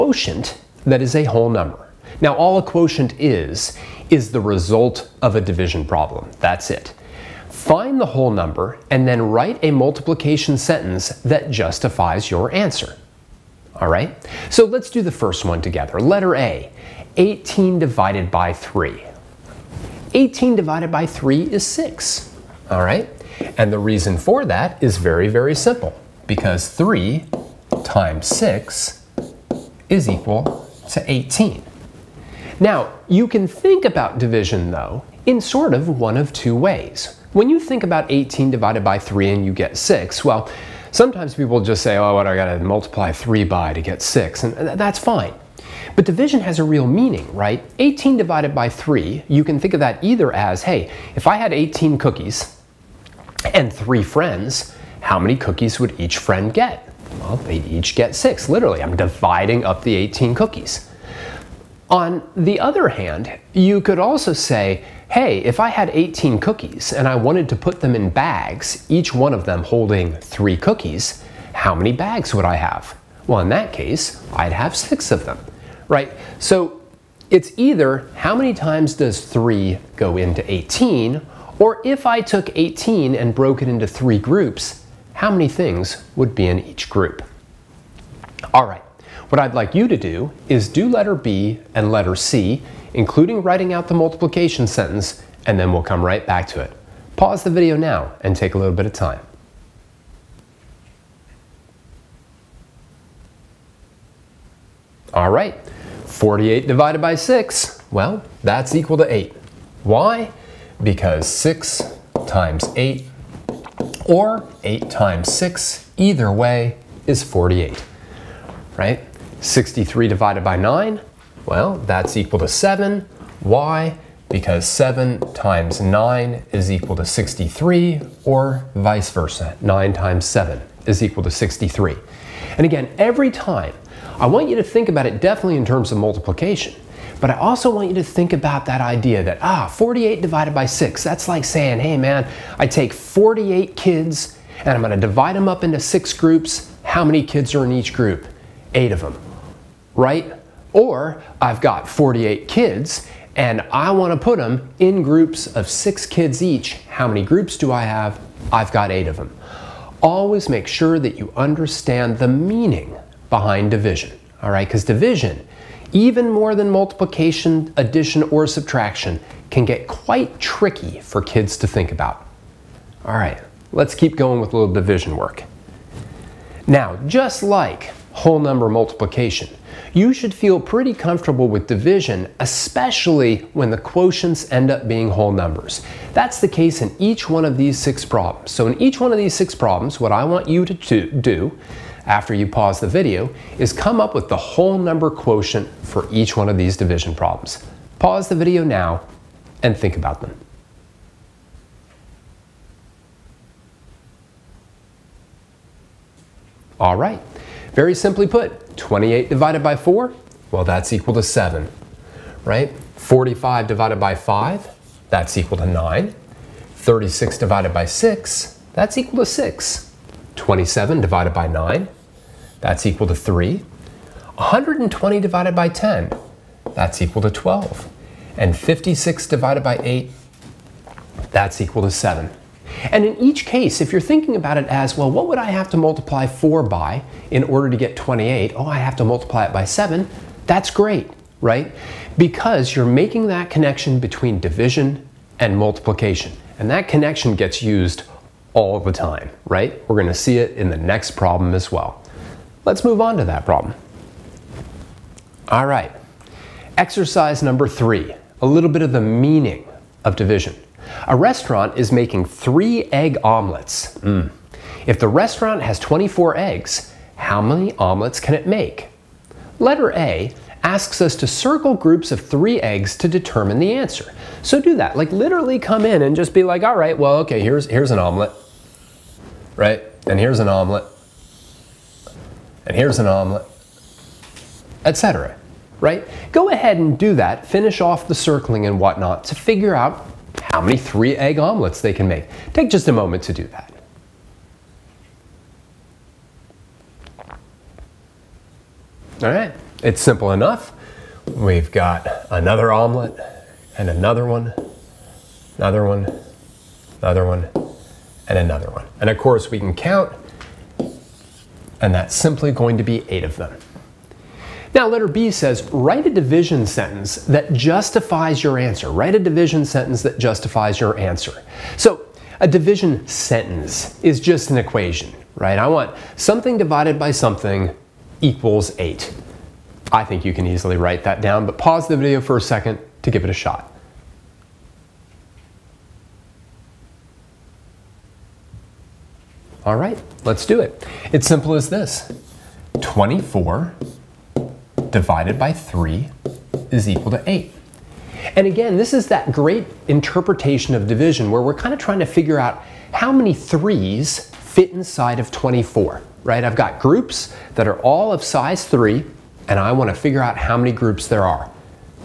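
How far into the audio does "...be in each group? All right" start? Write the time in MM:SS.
01:26.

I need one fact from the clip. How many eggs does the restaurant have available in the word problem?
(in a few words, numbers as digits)
24.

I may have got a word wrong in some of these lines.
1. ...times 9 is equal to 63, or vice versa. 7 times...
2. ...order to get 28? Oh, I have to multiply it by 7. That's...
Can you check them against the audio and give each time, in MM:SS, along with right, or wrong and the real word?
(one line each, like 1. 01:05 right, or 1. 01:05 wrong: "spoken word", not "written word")
1. 02:05 wrong: "9", not "7"
2. 03:57 right.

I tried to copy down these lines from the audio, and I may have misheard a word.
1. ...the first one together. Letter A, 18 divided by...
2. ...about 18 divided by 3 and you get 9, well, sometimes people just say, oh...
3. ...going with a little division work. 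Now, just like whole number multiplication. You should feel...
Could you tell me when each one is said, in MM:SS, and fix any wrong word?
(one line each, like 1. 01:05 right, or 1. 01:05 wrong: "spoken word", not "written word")
1. 00:15 right
2. 00:37 wrong: "6", not "9"
3. 02:54 right.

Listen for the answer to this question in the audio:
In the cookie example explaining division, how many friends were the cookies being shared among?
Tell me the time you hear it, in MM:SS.
00:53.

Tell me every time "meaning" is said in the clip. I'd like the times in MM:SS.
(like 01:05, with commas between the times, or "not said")
00:46, 02:42, 04:18.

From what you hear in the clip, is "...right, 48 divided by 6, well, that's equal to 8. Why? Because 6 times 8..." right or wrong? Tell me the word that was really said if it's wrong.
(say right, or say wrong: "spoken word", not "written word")
right.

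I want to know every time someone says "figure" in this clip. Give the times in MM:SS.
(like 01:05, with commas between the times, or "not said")
04:49, 05:52, 05:59.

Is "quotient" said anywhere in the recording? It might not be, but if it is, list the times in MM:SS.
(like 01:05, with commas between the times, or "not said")
00:02, 03:03, 03:15.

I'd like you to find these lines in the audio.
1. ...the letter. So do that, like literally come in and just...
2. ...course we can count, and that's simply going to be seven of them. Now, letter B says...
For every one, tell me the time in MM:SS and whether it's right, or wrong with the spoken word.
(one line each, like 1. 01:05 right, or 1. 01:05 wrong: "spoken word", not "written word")
1. 04:33 wrong: "answer", not "letter"
2. 05:09 wrong: "eight", not "seven".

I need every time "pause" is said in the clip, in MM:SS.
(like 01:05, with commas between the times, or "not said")
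01:37, 03:12, 03:17, 05:31.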